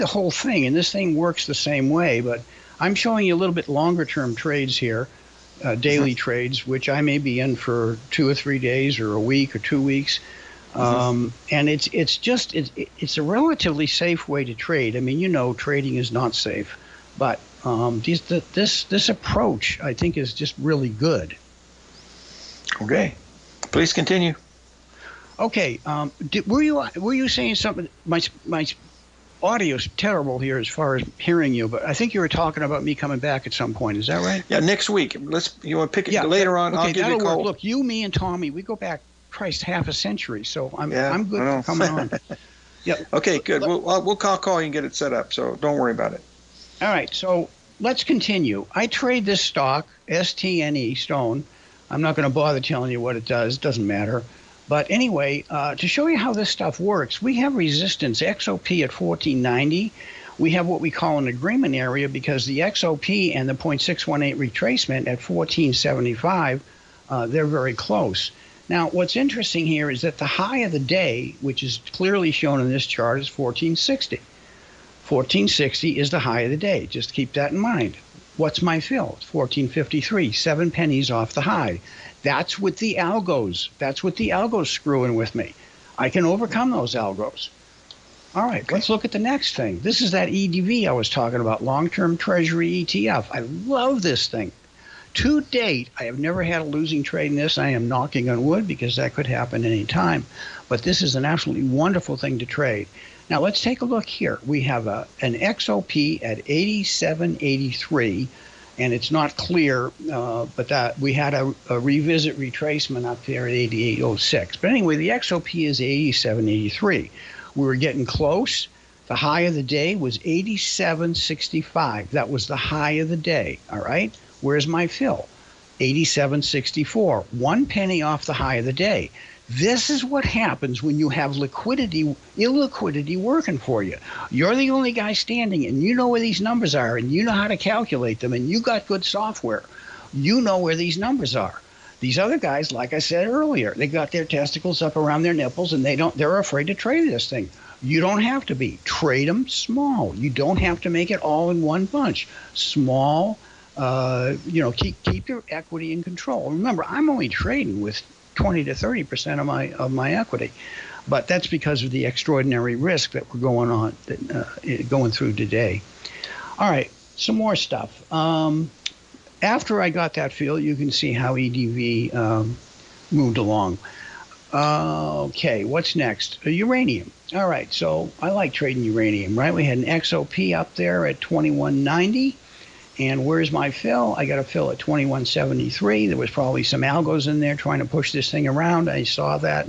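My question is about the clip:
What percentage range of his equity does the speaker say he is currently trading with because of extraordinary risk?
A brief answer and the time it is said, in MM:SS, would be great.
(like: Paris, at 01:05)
20 to 30 percent, at 02:38.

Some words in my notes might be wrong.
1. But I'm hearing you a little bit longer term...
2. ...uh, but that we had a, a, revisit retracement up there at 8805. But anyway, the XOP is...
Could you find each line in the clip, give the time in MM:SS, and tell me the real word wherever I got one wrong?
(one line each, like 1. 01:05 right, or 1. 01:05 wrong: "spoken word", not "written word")
1. 00:02 wrong: "showing", not "hearing"
2. 01:50 wrong: "8806", not "8805".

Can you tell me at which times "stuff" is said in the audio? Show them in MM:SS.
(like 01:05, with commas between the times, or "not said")
00:56, 02:47.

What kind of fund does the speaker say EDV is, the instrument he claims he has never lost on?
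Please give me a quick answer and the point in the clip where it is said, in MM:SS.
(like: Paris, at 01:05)
Long-term Treasury ETF, at 01:31.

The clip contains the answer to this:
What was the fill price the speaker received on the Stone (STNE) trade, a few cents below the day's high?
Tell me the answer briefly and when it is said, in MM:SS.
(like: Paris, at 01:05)
14.53, at 01:19.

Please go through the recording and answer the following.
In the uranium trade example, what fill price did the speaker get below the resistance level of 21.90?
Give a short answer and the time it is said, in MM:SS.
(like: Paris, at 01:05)
21.73, at 03:04.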